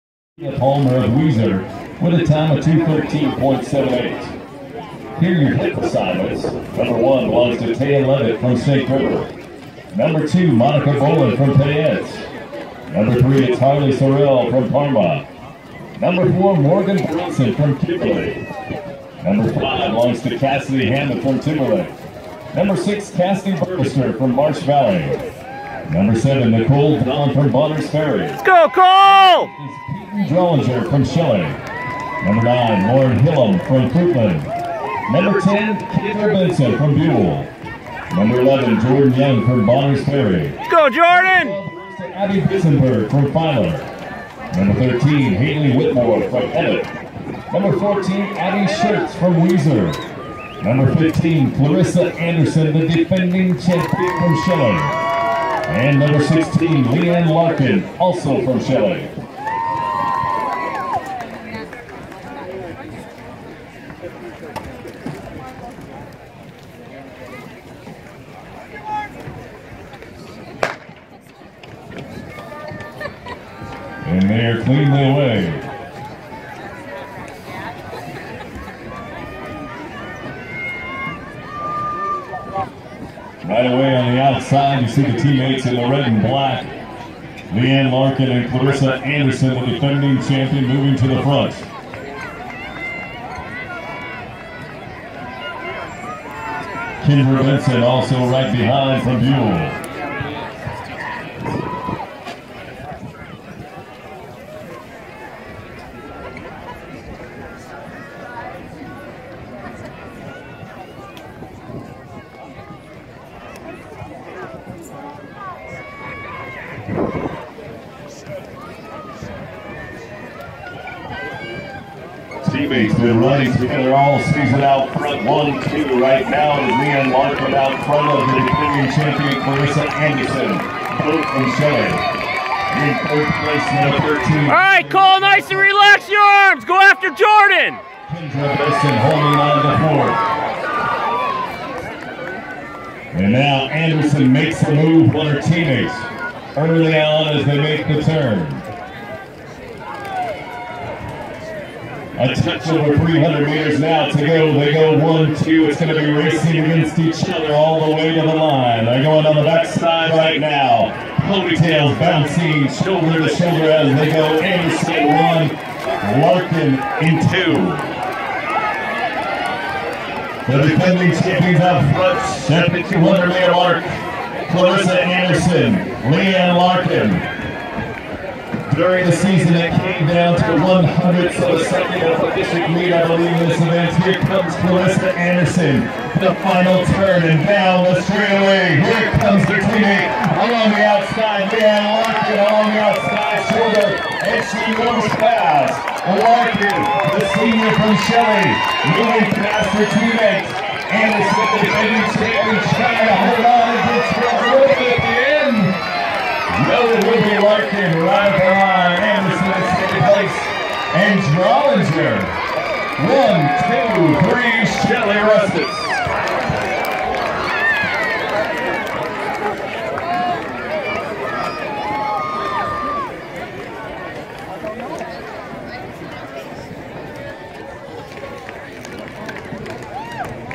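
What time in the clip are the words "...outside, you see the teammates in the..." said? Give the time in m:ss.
1:24.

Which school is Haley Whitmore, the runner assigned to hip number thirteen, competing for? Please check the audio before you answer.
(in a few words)
Emmett.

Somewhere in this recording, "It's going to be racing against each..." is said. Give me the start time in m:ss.
2:35.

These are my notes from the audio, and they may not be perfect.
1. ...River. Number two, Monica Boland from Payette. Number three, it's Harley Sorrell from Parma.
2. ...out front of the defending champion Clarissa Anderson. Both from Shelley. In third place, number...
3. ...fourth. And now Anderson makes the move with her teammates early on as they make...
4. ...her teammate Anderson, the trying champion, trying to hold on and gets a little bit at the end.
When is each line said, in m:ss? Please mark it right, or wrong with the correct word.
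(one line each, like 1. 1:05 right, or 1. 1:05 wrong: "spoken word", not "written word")
1. 0:08 right
2. 2:07 right
3. 2:22 right
4. 3:19 wrong: "defending", not "trying".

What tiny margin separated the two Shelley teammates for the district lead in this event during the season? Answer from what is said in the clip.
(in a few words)
100th of a second.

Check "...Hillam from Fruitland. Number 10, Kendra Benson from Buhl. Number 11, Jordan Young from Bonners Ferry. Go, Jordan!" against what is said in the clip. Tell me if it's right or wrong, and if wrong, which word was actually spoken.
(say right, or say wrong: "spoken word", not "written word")
right.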